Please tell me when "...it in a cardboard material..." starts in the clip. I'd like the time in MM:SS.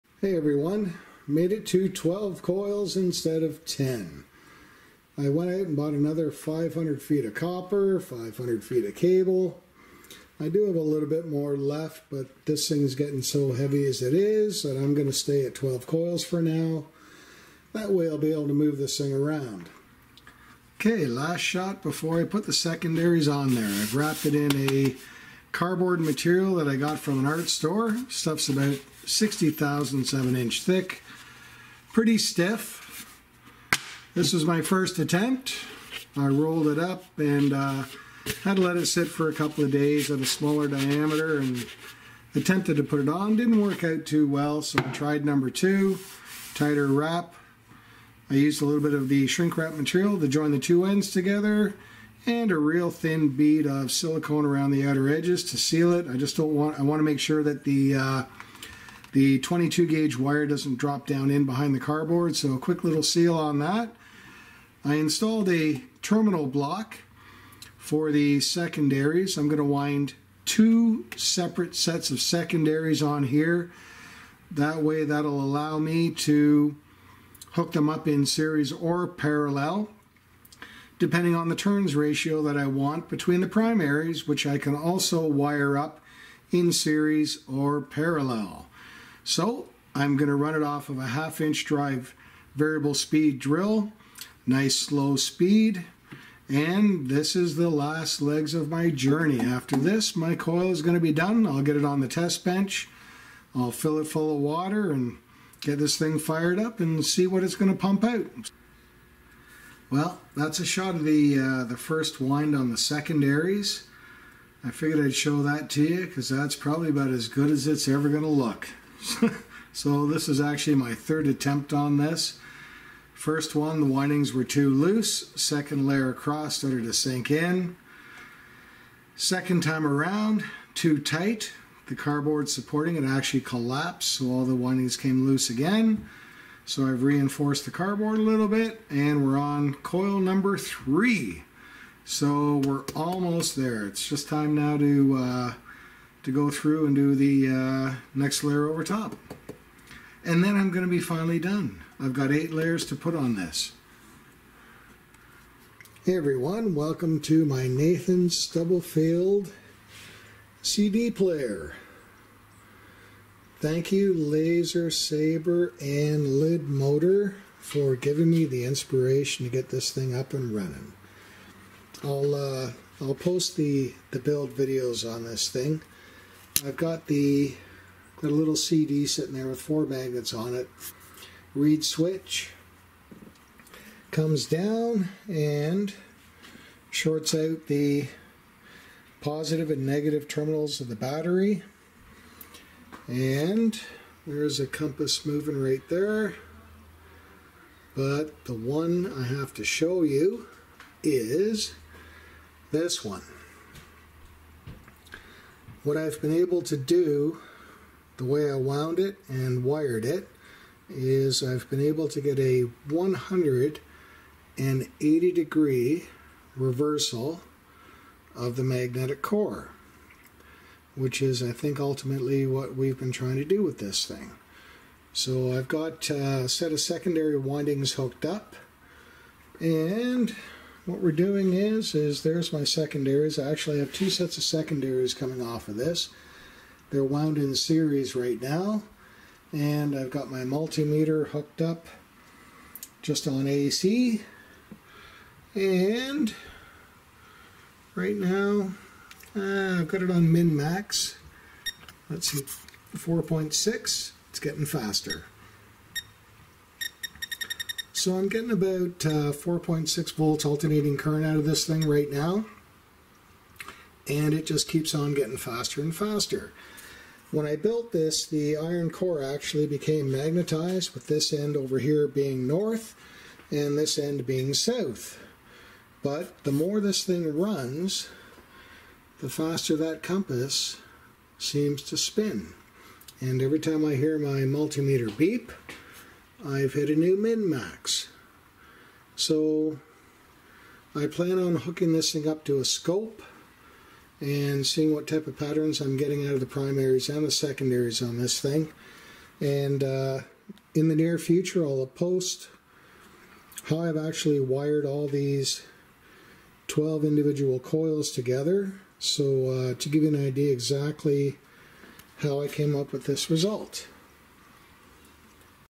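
00:24.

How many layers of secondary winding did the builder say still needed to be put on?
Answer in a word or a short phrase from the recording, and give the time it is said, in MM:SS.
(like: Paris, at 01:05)
8, at 02:32.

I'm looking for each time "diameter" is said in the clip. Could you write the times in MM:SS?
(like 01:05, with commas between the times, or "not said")
00:40.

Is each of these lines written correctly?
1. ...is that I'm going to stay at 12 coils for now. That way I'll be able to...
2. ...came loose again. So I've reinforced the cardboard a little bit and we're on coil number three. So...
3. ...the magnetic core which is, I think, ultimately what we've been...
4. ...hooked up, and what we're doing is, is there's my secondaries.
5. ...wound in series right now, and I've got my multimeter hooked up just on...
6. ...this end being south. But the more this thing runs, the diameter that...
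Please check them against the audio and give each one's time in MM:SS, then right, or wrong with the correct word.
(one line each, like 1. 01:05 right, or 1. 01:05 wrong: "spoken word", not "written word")
1. 00:14 right
2. 02:14 right
3. 03:38 right
4. 03:47 right
5. 03:57 right
6. 04:33 wrong: "faster", not "diameter".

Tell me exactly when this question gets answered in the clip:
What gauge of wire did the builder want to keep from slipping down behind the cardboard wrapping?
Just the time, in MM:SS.
00:59.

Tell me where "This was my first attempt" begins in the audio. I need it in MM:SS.
00:34.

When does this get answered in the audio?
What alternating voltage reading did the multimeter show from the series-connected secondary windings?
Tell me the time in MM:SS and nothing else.
04:19.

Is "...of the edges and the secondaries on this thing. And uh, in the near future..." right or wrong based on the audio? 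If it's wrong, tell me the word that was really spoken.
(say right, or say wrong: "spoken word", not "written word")
wrong: "primaries", not "edges".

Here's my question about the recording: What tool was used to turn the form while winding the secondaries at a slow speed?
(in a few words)
half inch drive variable speed drill.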